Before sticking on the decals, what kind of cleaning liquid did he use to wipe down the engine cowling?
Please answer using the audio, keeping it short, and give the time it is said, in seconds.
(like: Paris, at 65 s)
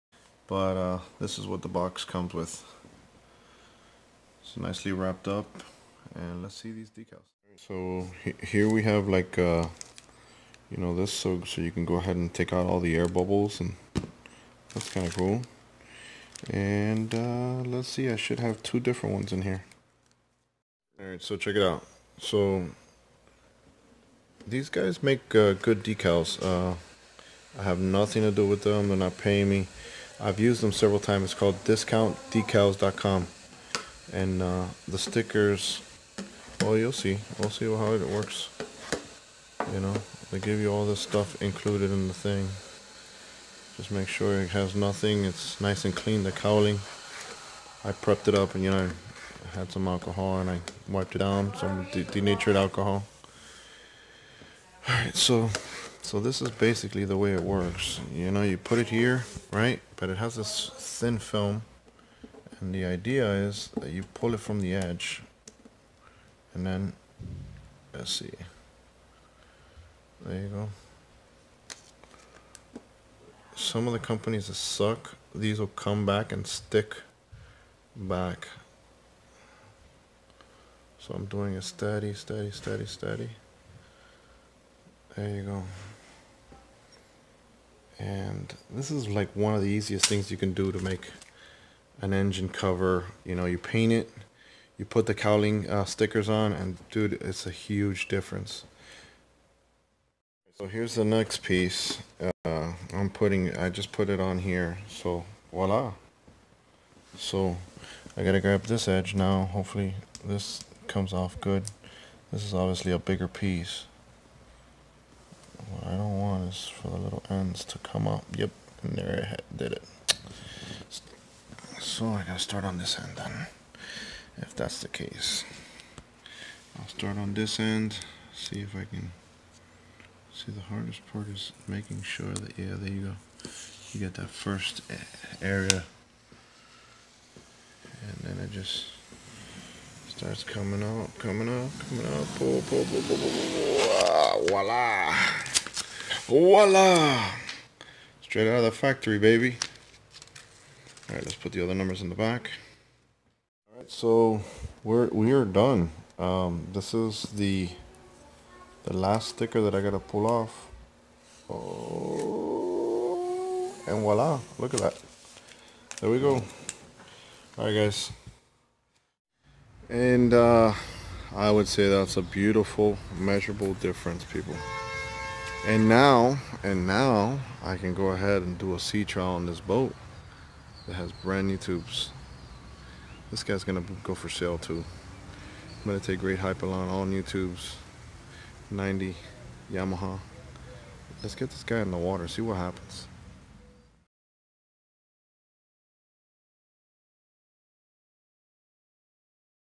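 denatured alcohol, at 52 s.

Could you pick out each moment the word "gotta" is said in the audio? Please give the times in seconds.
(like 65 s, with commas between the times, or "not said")
108 s, 122 s, 159 s.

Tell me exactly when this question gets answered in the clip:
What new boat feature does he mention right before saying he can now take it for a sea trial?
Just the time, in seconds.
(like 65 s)
181 s.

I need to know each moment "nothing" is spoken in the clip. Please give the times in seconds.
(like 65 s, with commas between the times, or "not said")
27 s, 44 s.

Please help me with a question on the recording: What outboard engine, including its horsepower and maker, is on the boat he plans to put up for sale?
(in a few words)
90 Yamaha.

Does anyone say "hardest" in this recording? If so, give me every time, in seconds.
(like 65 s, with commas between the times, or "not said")
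130 s.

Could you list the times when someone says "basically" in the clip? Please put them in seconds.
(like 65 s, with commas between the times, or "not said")
56 s.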